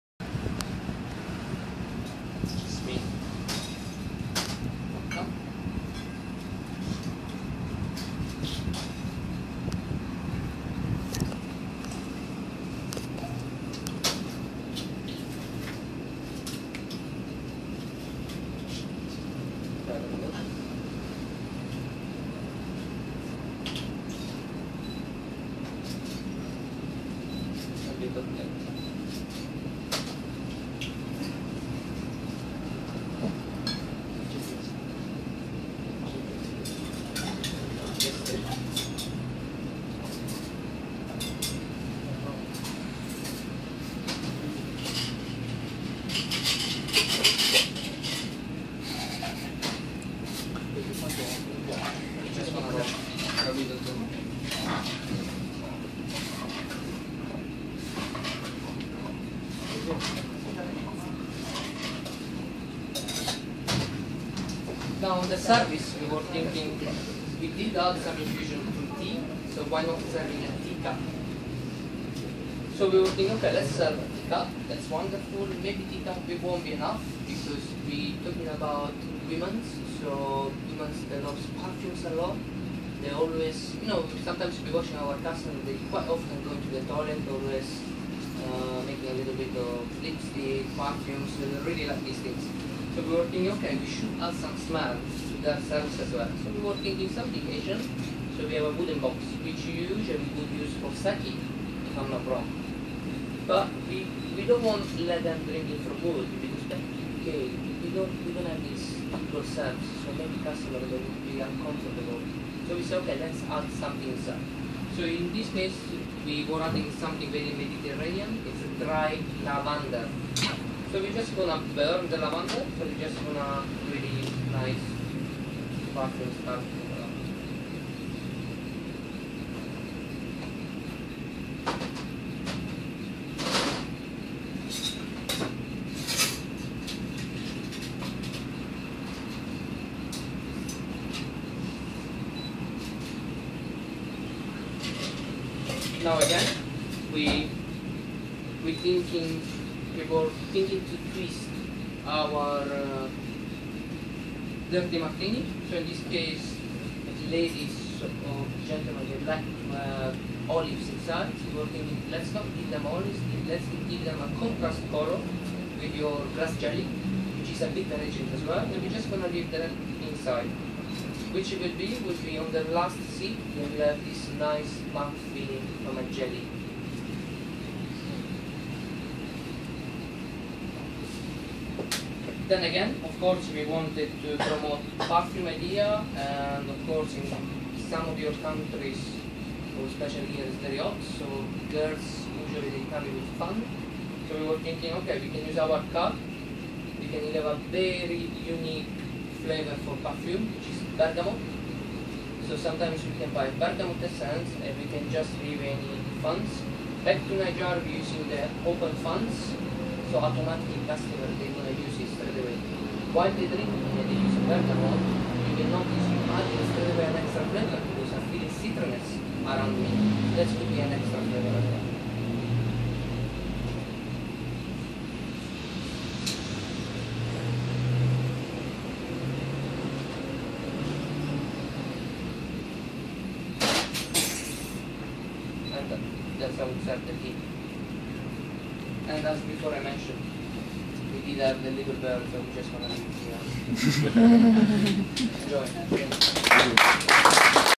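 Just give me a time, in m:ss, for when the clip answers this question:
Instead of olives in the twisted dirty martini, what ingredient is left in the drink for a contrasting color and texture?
2:46.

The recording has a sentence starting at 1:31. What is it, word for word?
So they really like these things.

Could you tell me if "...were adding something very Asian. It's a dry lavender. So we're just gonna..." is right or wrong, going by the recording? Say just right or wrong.
wrong.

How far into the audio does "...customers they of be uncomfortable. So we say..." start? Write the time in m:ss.
1:50.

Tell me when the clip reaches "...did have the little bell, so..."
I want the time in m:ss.
4:01.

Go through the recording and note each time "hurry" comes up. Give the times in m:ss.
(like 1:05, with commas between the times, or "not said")
not said.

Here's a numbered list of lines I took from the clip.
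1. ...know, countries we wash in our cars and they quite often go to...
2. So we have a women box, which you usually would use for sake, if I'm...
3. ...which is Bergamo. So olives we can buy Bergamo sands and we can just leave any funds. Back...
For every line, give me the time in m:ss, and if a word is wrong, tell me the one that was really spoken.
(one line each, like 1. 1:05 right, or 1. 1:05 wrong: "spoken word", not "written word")
1. 1:23 wrong: "sometimes", not "countries"
2. 1:38 wrong: "wooden", not "women"
3. 3:20 wrong: "sometimes", not "olives".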